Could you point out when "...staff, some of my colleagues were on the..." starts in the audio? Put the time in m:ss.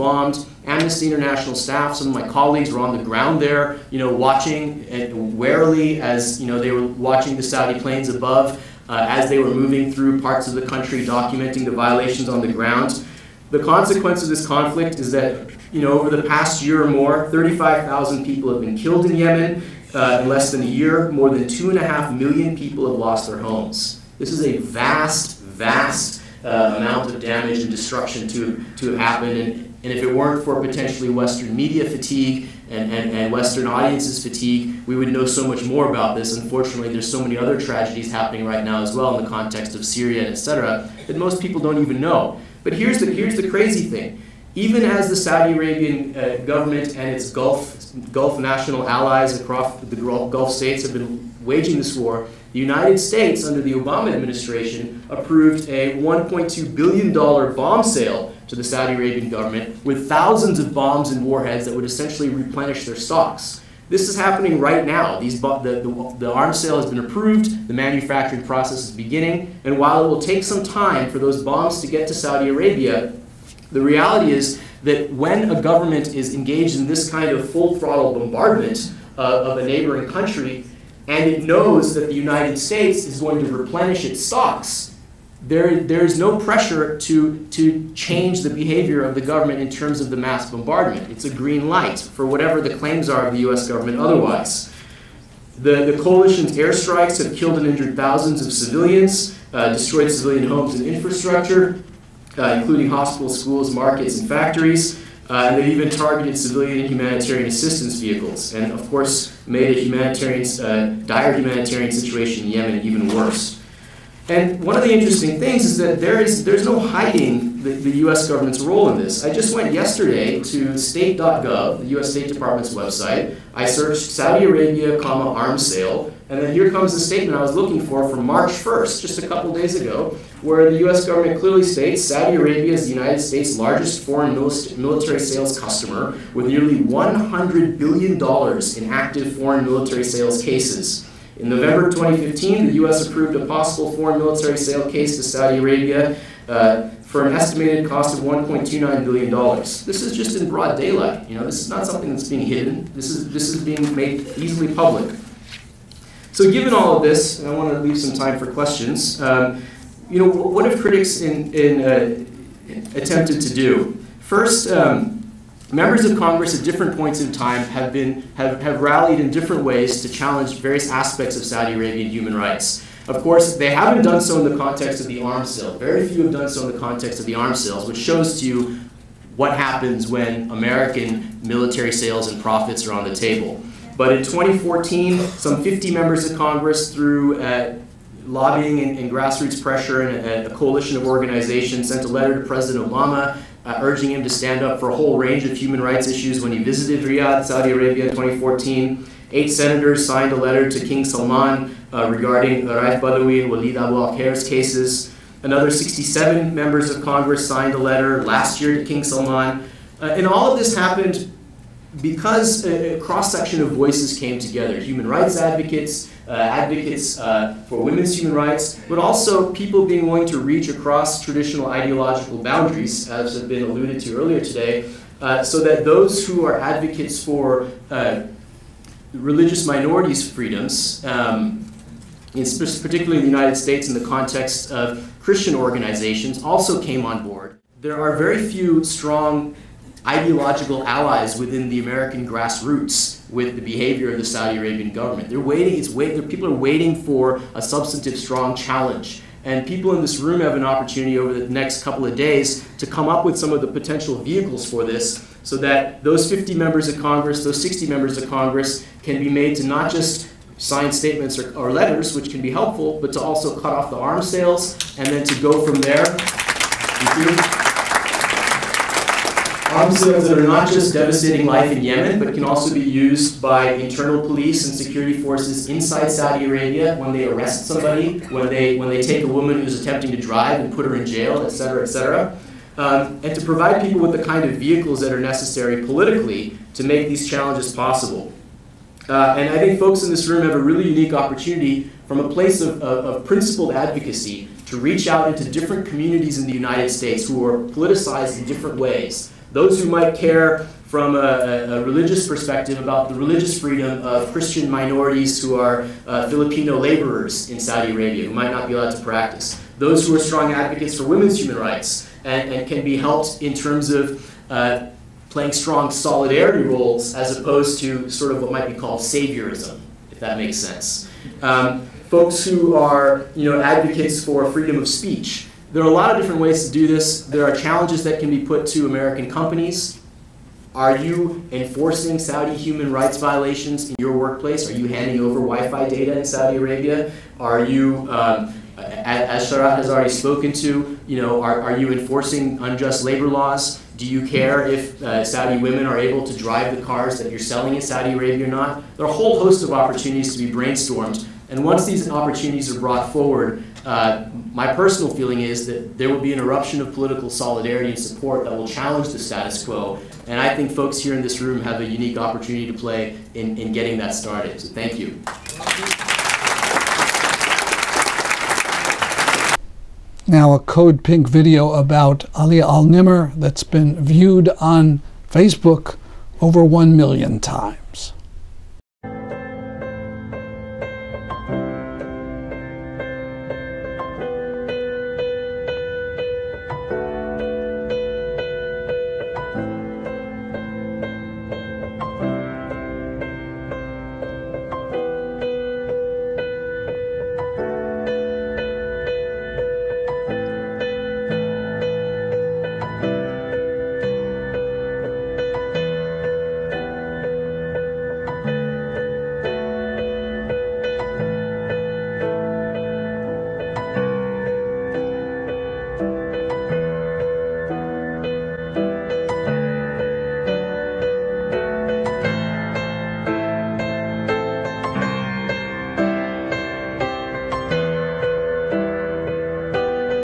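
0:01.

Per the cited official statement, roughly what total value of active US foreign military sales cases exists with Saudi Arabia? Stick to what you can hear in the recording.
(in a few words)
nearly $100 billion.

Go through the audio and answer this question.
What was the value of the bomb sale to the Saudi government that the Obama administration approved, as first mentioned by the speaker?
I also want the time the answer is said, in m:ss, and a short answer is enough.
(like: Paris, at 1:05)
$1.2 billion, at 0:55.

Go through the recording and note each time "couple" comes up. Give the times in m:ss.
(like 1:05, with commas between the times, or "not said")
2:09, 4:11.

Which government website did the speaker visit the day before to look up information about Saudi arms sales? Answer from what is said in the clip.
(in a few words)
state.gov.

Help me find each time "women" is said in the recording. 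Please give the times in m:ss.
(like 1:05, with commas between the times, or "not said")
3:37, 5:11, 5:45.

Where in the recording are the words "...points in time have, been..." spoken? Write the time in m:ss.
2:46.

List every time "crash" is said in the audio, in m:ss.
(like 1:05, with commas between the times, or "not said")
not said.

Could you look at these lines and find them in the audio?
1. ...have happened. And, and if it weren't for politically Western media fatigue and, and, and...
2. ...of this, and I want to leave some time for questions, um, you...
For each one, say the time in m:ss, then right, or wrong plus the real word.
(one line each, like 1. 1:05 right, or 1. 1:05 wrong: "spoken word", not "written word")
1. 0:28 wrong: "potentially", not "politically"
2. 2:36 right.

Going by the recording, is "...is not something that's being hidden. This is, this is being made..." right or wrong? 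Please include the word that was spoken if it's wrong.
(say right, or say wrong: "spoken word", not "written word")
right.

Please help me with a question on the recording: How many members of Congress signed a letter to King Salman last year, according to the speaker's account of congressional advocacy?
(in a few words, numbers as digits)
67.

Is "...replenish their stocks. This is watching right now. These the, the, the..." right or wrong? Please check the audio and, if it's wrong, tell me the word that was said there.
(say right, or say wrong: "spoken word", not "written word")
wrong: "happening", not "watching".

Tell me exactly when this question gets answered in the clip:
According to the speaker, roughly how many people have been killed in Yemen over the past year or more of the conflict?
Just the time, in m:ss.
0:17.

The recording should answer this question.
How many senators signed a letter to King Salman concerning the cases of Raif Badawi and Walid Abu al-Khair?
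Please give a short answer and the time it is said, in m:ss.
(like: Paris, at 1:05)
8, at 3:19.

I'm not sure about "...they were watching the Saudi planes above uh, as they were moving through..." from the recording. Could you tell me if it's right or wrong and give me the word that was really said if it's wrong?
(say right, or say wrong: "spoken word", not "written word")
right.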